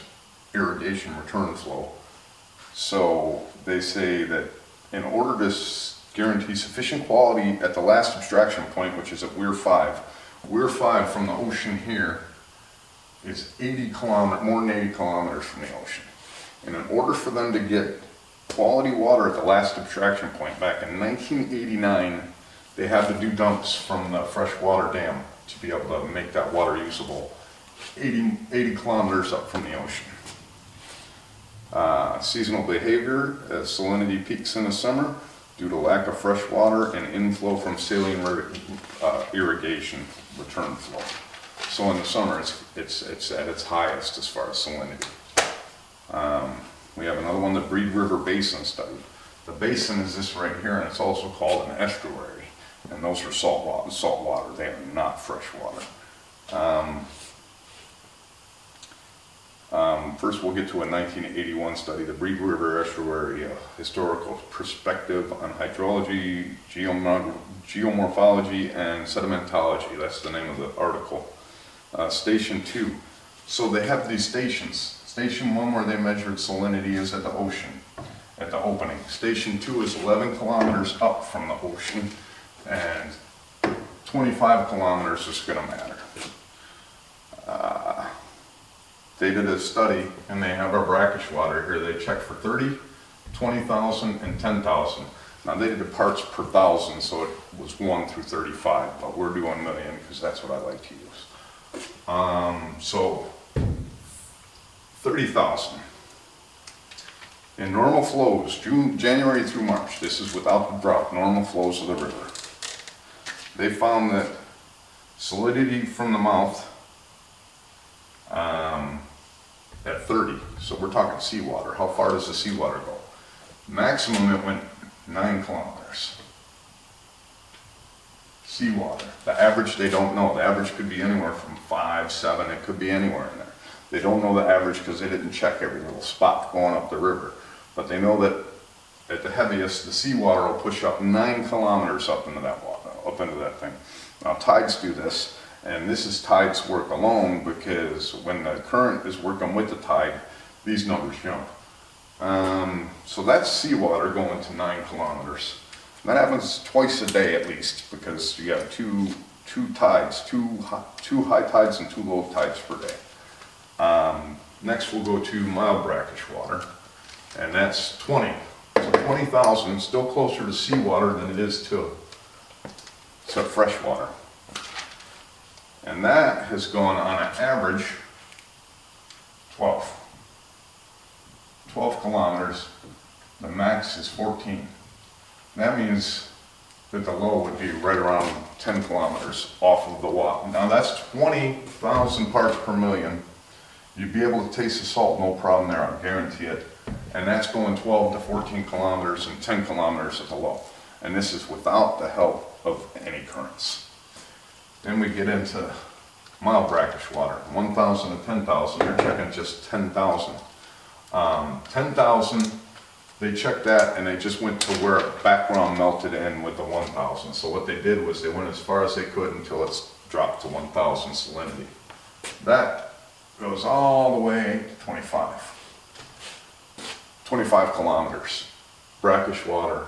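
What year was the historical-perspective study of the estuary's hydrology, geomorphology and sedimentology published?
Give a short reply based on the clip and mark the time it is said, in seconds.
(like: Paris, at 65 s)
1981, at 60 s.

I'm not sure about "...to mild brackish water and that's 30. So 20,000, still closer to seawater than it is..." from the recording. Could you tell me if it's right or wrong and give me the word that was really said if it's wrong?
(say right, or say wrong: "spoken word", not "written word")
wrong: "20", not "30".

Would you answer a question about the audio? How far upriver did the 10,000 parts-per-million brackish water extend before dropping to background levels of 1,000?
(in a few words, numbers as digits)
25 kilometers.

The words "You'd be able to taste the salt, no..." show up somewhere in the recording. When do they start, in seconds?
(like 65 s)
193 s.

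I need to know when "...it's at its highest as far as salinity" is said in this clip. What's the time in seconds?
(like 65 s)
43 s.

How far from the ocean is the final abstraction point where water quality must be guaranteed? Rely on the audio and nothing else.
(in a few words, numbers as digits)
80 kilometers.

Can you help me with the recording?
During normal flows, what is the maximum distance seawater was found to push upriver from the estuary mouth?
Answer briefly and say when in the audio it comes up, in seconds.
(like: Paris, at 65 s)
9 kilometers, at 125 s.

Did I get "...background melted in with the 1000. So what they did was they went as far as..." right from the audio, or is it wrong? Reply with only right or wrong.
right.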